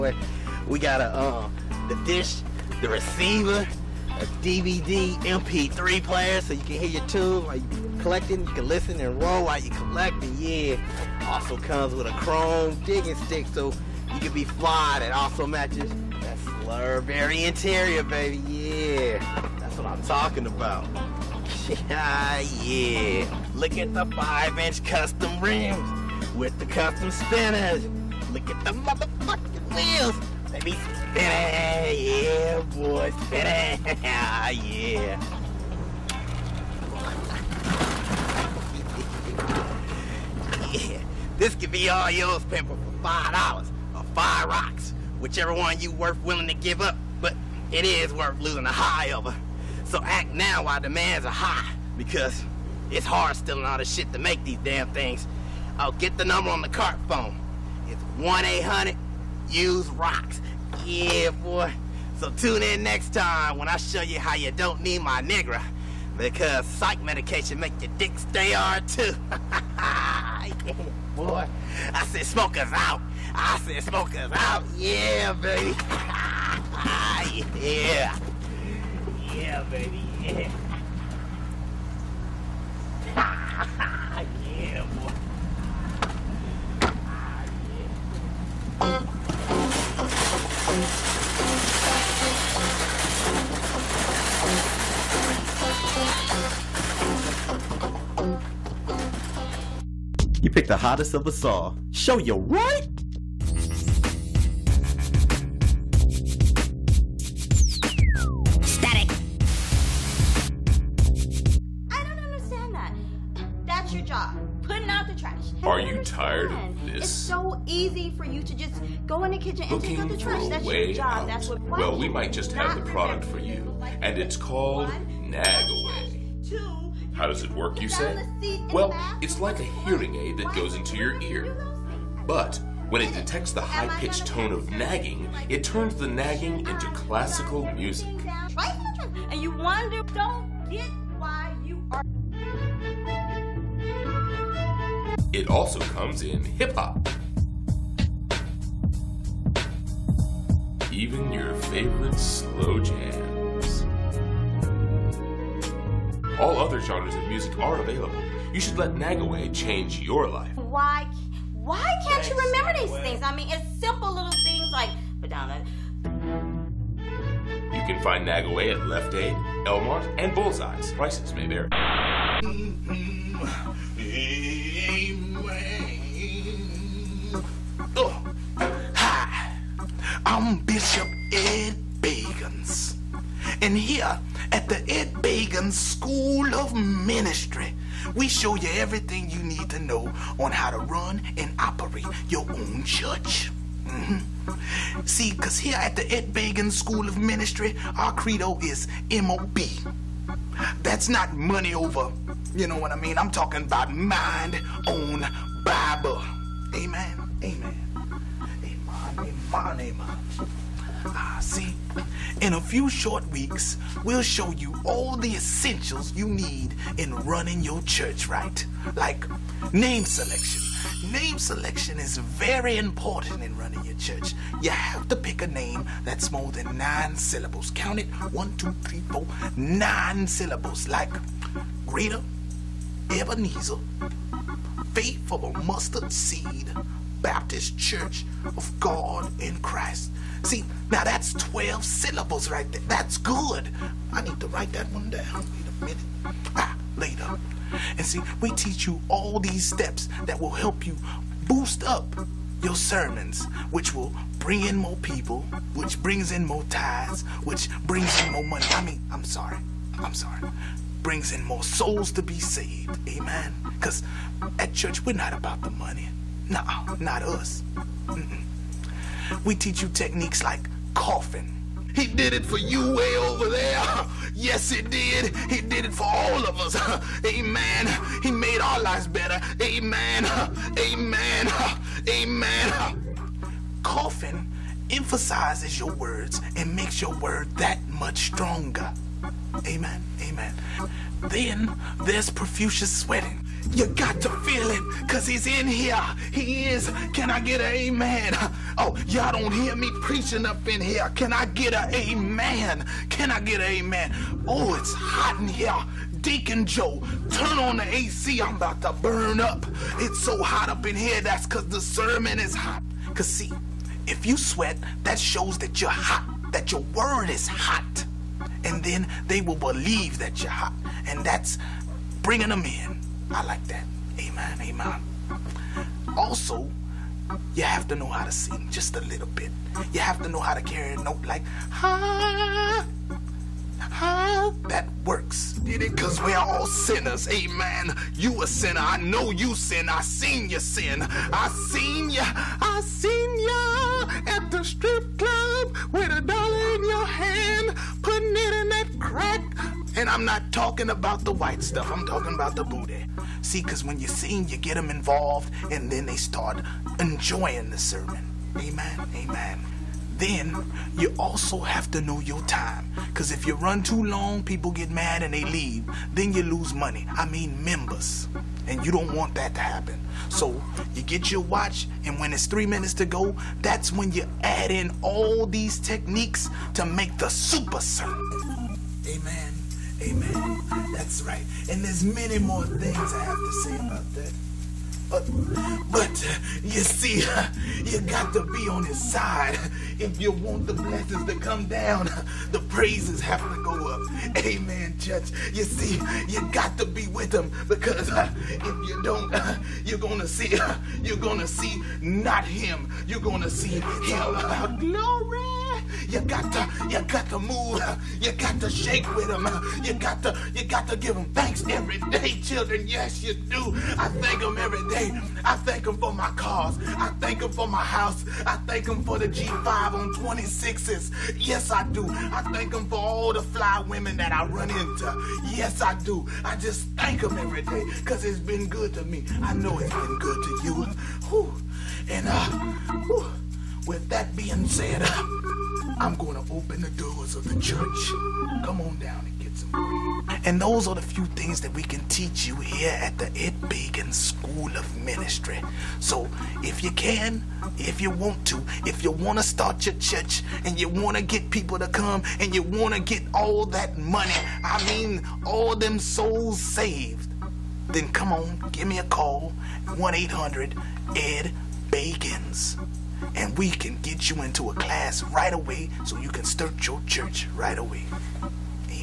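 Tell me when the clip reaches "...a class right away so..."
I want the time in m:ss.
7:44.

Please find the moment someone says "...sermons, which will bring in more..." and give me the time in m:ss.
4:12.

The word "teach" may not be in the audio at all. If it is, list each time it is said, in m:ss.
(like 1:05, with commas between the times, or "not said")
4:08, 4:29, 7:22.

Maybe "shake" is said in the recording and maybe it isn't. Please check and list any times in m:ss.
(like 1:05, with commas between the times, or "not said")
6:48.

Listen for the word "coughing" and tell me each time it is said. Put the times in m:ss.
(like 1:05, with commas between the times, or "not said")
4:30, 4:43.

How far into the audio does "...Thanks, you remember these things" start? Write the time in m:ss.
2:42.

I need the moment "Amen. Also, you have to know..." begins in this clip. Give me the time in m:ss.
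5:24.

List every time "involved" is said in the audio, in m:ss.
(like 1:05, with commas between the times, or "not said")
5:54.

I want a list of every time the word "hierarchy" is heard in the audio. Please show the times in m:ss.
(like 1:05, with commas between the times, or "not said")
not said.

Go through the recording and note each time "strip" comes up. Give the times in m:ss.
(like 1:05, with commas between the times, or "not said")
5:44.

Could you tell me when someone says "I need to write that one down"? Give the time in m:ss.
4:04.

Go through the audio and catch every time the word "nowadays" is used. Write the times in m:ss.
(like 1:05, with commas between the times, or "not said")
not said.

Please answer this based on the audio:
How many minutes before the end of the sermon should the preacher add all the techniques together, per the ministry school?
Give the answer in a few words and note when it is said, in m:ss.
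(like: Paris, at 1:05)
3, at 6:12.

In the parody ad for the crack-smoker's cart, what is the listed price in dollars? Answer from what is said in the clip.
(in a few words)
$5.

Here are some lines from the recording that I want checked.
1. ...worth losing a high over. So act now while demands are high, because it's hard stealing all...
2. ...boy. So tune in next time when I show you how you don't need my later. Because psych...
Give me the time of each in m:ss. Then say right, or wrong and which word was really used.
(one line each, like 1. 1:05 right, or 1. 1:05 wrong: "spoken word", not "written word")
1. 0:48 right
2. 1:01 wrong: "nigger", not "later".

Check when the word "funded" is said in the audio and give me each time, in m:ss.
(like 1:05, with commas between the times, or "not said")
not said.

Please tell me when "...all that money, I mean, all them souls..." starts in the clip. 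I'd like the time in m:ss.
7:33.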